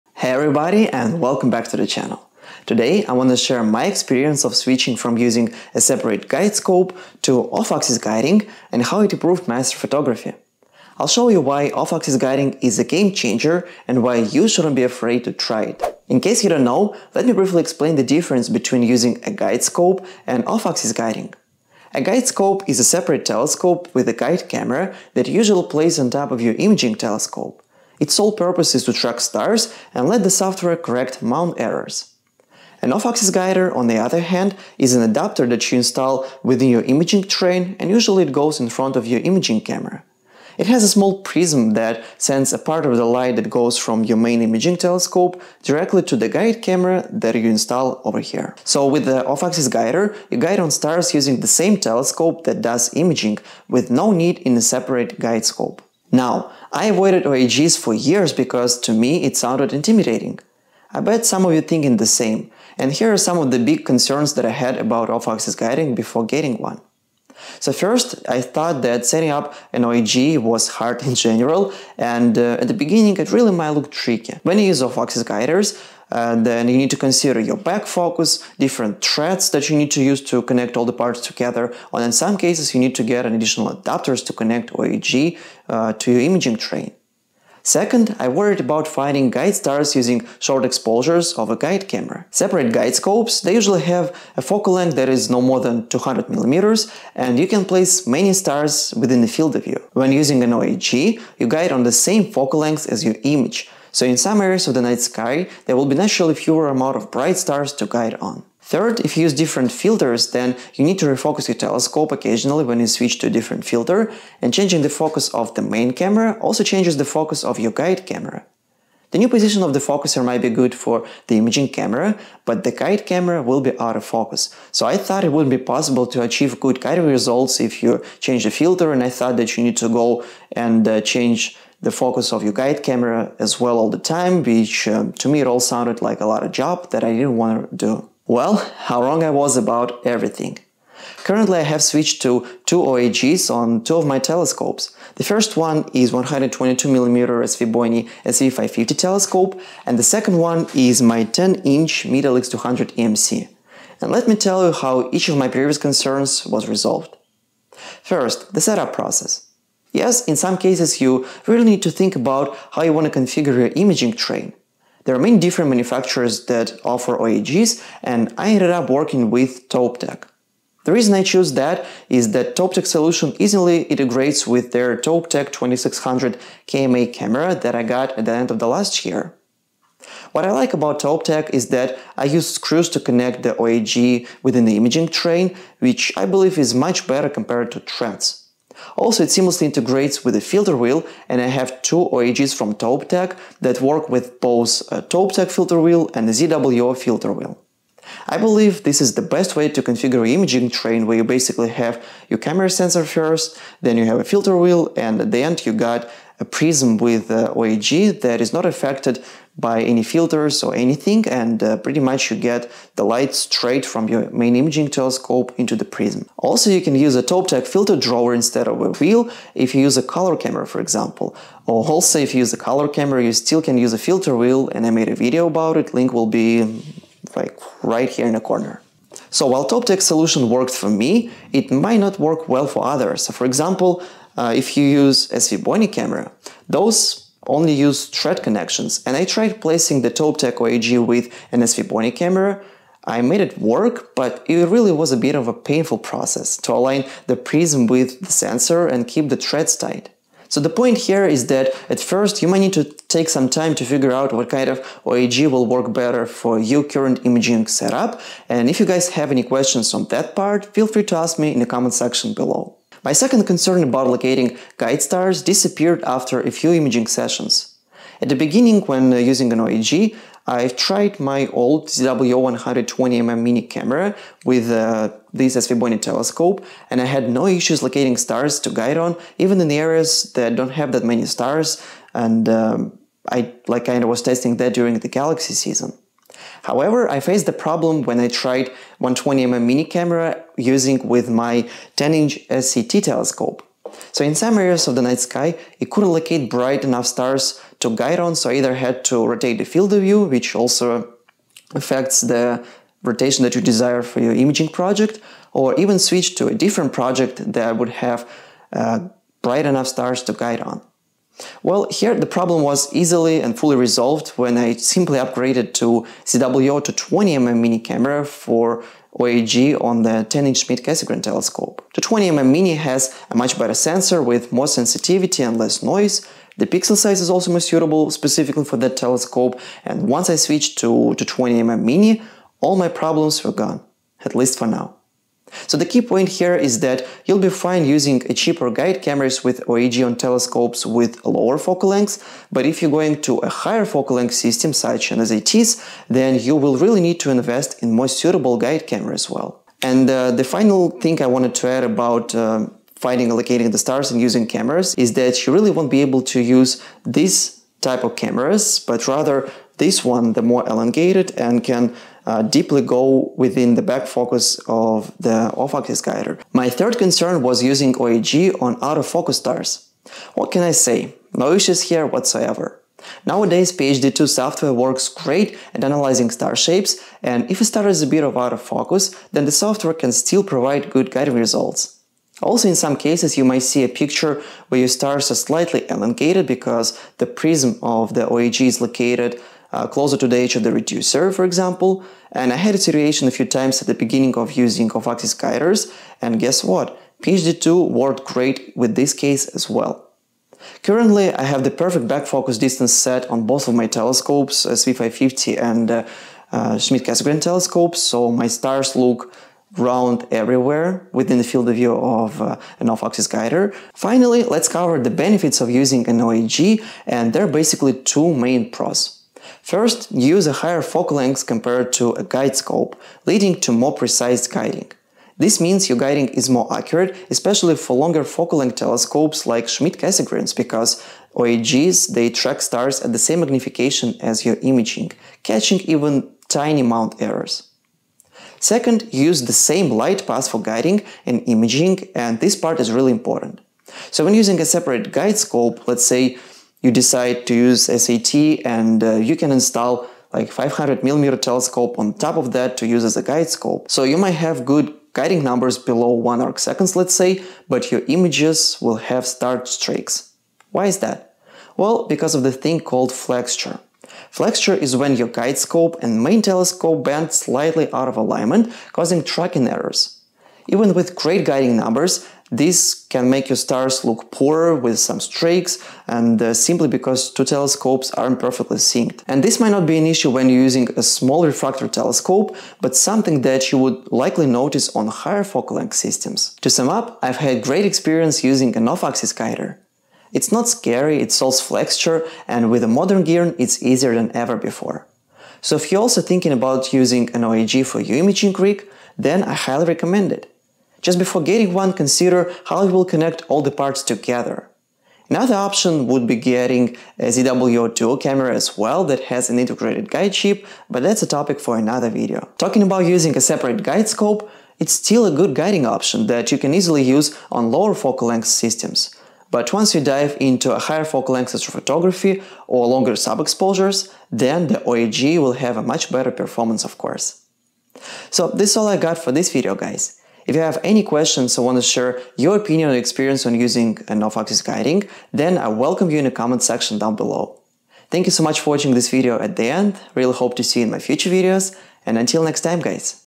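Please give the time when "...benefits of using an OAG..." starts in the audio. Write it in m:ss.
6:55.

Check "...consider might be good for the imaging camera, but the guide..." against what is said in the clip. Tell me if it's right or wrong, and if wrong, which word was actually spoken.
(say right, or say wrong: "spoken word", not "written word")
wrong: "focuser", not "consider".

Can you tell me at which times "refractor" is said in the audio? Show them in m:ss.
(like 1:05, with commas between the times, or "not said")
8:01.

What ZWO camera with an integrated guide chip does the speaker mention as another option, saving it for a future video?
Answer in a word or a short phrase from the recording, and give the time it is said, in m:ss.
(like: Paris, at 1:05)
ZWO Duo, at 8:27.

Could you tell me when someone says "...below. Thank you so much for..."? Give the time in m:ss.
8:57.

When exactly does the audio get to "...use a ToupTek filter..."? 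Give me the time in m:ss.
3:36.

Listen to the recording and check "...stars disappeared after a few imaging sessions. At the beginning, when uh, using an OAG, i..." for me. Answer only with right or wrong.
right.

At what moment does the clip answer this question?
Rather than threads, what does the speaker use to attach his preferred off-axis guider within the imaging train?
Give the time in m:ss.
3:02.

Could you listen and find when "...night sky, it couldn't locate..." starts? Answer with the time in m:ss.
4:55.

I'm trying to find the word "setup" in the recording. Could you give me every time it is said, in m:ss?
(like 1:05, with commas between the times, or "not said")
2:38, 4:17.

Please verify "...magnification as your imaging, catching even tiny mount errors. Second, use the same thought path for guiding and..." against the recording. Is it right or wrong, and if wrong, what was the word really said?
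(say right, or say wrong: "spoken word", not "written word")
wrong: "light", not "thought".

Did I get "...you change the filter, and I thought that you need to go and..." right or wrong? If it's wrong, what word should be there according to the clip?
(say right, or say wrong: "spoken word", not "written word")
right.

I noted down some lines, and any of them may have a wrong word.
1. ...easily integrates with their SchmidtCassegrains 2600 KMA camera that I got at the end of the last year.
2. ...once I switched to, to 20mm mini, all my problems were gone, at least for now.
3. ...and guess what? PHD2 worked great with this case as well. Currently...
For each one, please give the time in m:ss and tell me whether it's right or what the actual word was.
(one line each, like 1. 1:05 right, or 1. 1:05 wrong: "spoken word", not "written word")
1. 2:53 wrong: "ToupTek", not "SchmidtCassegrains"
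2. 5:30 right
3. 6:36 right.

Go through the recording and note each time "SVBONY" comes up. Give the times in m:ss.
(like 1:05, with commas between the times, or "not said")
2:27, 3:55, 4:01, 4:35.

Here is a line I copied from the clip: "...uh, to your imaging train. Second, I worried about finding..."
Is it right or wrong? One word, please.
right.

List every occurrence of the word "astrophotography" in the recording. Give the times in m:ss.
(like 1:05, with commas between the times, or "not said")
0:09, 8:41.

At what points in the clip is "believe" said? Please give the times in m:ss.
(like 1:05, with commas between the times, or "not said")
3:06, 3:18.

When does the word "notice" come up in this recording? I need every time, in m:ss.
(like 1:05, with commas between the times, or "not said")
8:04.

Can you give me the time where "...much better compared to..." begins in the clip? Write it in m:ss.
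3:06.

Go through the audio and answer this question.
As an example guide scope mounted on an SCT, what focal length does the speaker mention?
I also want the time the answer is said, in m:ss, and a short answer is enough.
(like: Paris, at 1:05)
500 millimeter, at 7:30.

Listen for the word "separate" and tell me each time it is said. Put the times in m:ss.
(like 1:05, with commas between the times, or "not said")
0:05, 0:22, 0:54, 1:32, 7:24, 8:33.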